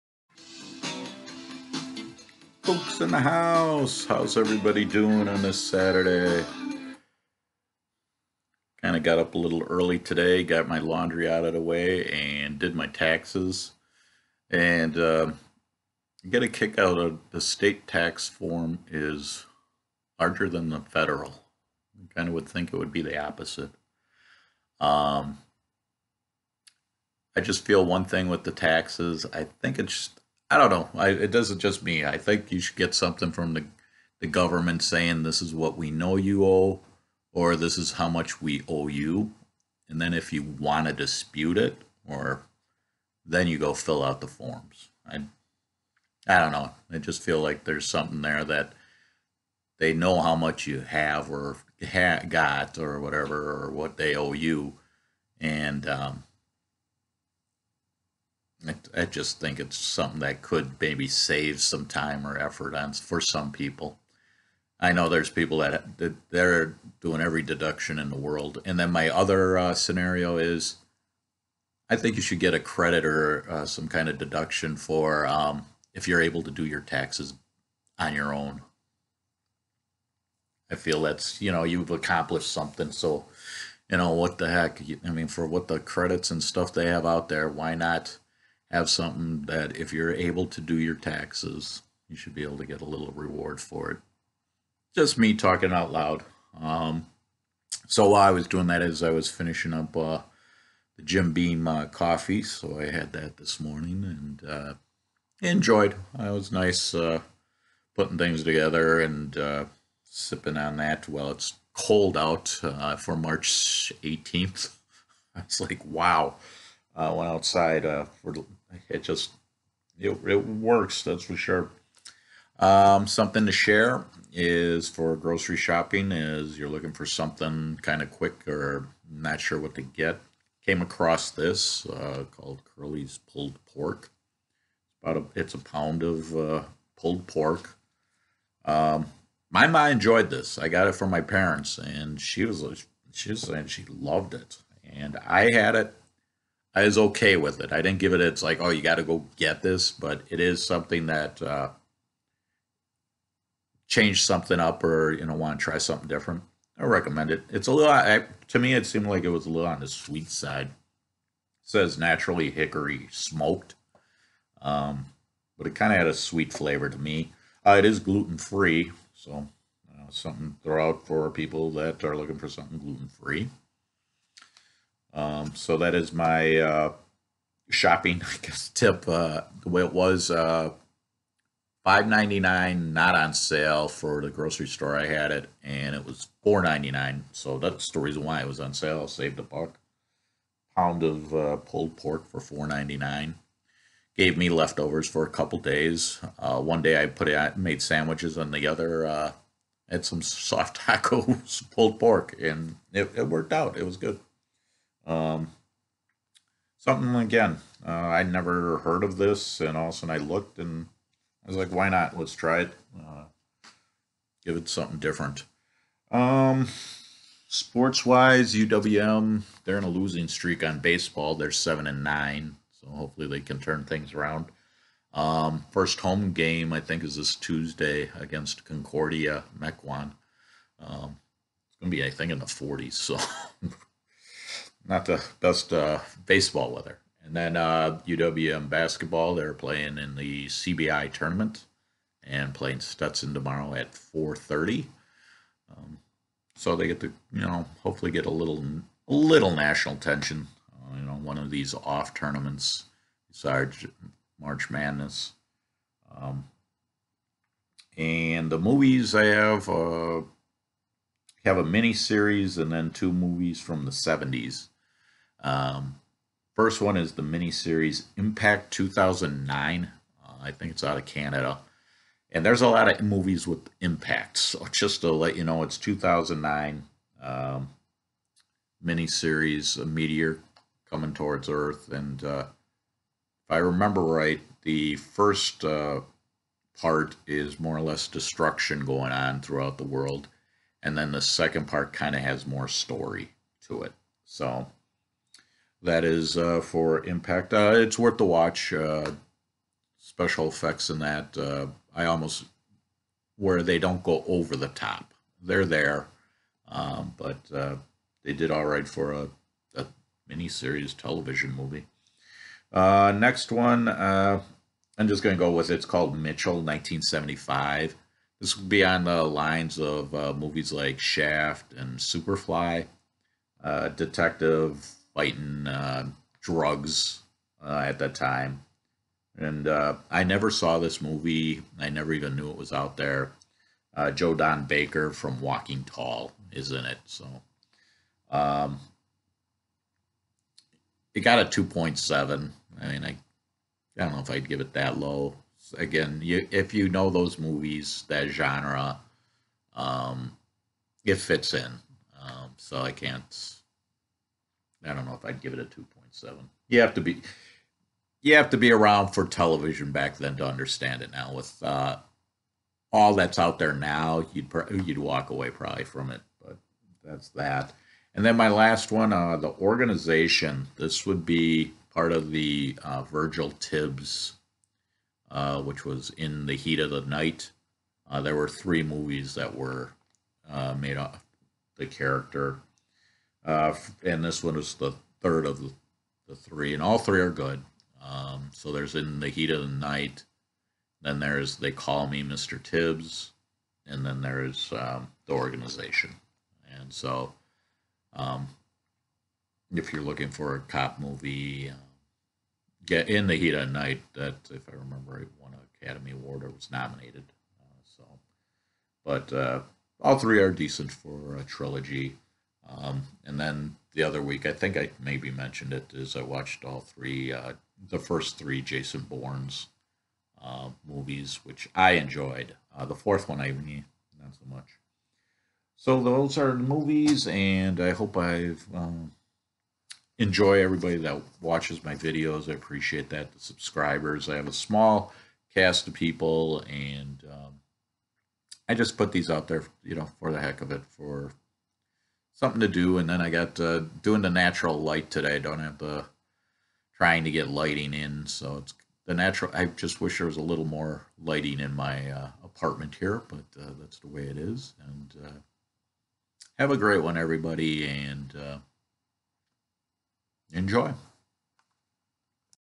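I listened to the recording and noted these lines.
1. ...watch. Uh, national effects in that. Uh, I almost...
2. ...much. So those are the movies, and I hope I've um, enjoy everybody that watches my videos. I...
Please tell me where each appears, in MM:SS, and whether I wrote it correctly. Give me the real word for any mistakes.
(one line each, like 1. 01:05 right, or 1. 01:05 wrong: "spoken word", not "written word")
1. 04:58 wrong: "special", not "national"
2. 07:04 right.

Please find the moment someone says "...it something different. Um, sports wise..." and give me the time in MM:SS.
03:34.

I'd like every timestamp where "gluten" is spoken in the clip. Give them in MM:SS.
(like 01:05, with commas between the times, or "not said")
02:47, 02:52.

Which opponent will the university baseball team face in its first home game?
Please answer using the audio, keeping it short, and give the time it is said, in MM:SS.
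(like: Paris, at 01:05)
Concordia Mequon, at 03:48.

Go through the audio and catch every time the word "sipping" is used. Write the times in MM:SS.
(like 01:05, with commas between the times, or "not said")
01:50.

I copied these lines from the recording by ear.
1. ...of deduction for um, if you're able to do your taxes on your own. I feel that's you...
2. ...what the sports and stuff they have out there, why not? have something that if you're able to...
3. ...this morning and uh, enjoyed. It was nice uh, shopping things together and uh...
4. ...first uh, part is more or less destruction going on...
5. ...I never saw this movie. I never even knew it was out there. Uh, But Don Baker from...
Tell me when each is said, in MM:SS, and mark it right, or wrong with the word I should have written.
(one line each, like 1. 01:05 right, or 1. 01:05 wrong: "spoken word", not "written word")
1. 01:14 right
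2. 01:25 wrong: "credits", not "sports"
3. 01:43 wrong: "putting", not "shopping"
4. 04:44 right
5. 05:30 wrong: "Joe", not "But".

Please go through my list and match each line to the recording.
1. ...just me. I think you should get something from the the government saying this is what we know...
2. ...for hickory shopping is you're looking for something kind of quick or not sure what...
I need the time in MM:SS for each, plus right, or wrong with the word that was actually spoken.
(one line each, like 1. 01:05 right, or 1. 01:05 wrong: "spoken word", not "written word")
1. 00:31 right
2. 02:04 wrong: "grocery", not "hickory".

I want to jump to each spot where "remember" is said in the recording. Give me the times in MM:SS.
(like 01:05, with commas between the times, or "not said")
04:43, 06:44.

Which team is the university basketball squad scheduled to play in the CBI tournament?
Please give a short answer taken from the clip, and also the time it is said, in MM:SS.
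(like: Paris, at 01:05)
Stetson, at 04:02.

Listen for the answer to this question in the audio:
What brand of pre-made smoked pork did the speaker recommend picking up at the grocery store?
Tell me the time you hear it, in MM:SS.
02:12.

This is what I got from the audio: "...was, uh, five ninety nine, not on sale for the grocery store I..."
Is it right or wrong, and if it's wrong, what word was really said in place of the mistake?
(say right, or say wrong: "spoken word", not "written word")
right.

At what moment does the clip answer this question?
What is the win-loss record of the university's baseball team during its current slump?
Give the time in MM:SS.
03:41.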